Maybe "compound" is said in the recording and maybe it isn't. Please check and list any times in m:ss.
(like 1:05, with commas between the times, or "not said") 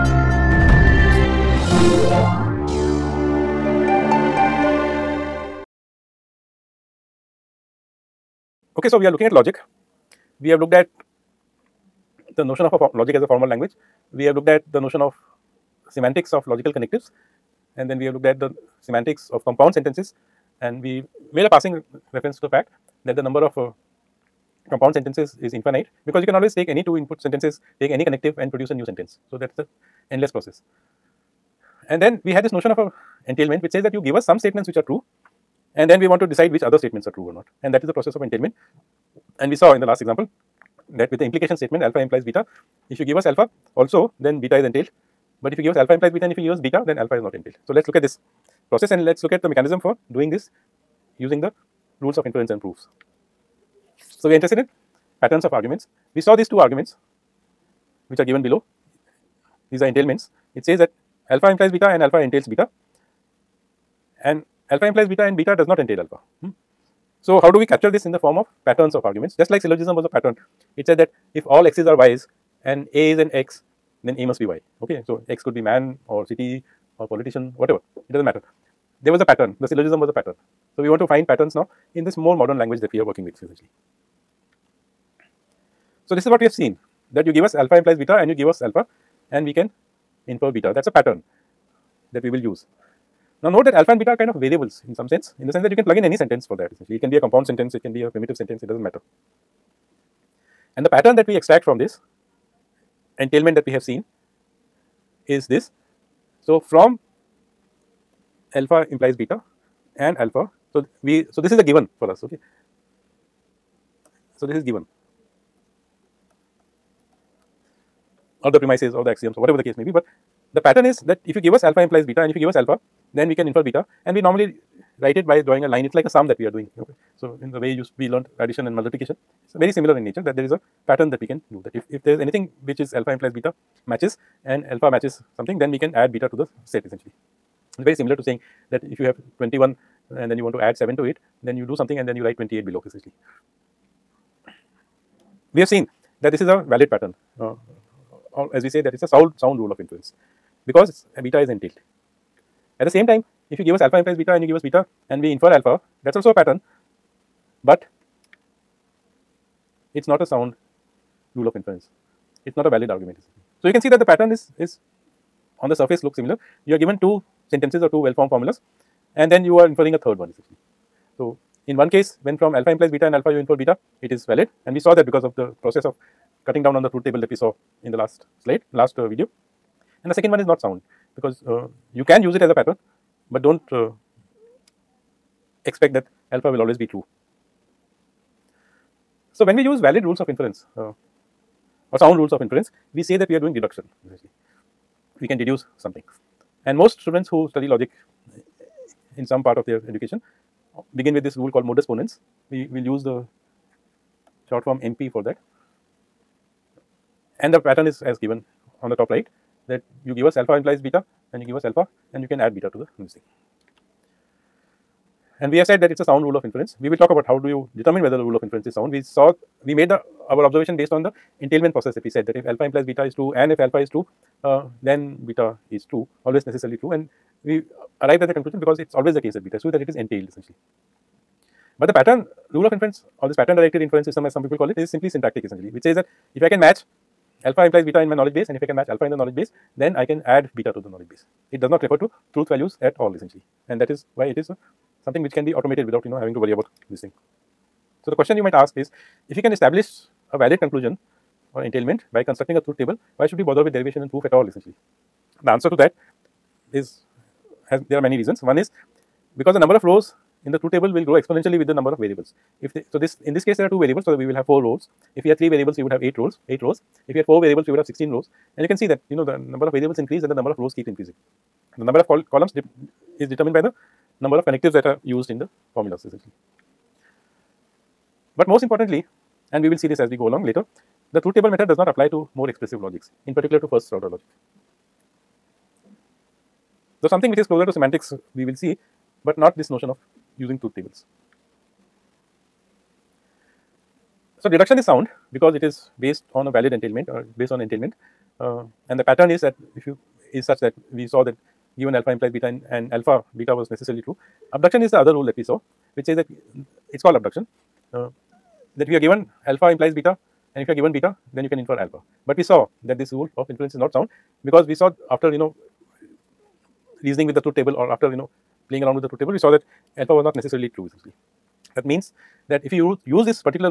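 0:19, 0:24, 1:37.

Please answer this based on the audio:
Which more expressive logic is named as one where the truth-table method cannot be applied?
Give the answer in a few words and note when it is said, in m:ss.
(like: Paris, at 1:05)
first order logic, at 4:43.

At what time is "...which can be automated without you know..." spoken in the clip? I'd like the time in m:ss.
4:05.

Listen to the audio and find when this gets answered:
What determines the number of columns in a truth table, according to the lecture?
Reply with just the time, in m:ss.
4:34.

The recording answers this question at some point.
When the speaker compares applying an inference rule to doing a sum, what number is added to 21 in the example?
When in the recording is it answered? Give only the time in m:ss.
2:20.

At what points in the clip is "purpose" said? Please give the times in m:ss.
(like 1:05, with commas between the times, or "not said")
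not said.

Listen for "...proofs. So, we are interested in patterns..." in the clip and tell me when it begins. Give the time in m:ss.
0:52.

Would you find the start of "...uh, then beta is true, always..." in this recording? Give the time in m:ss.
3:44.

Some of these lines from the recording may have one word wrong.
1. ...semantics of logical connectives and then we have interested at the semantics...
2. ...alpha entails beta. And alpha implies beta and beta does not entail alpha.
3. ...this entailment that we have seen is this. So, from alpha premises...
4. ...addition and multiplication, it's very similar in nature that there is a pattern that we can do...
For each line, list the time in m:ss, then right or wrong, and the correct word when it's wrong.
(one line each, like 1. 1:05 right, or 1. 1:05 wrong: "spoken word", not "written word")
1. 0:15 wrong: "looked", not "interested"
2. 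1:02 right
3. 1:41 wrong: "implies", not "premises"
4. 2:08 right.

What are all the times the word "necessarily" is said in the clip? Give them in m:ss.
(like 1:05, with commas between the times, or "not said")
3:46, 5:03, 5:20.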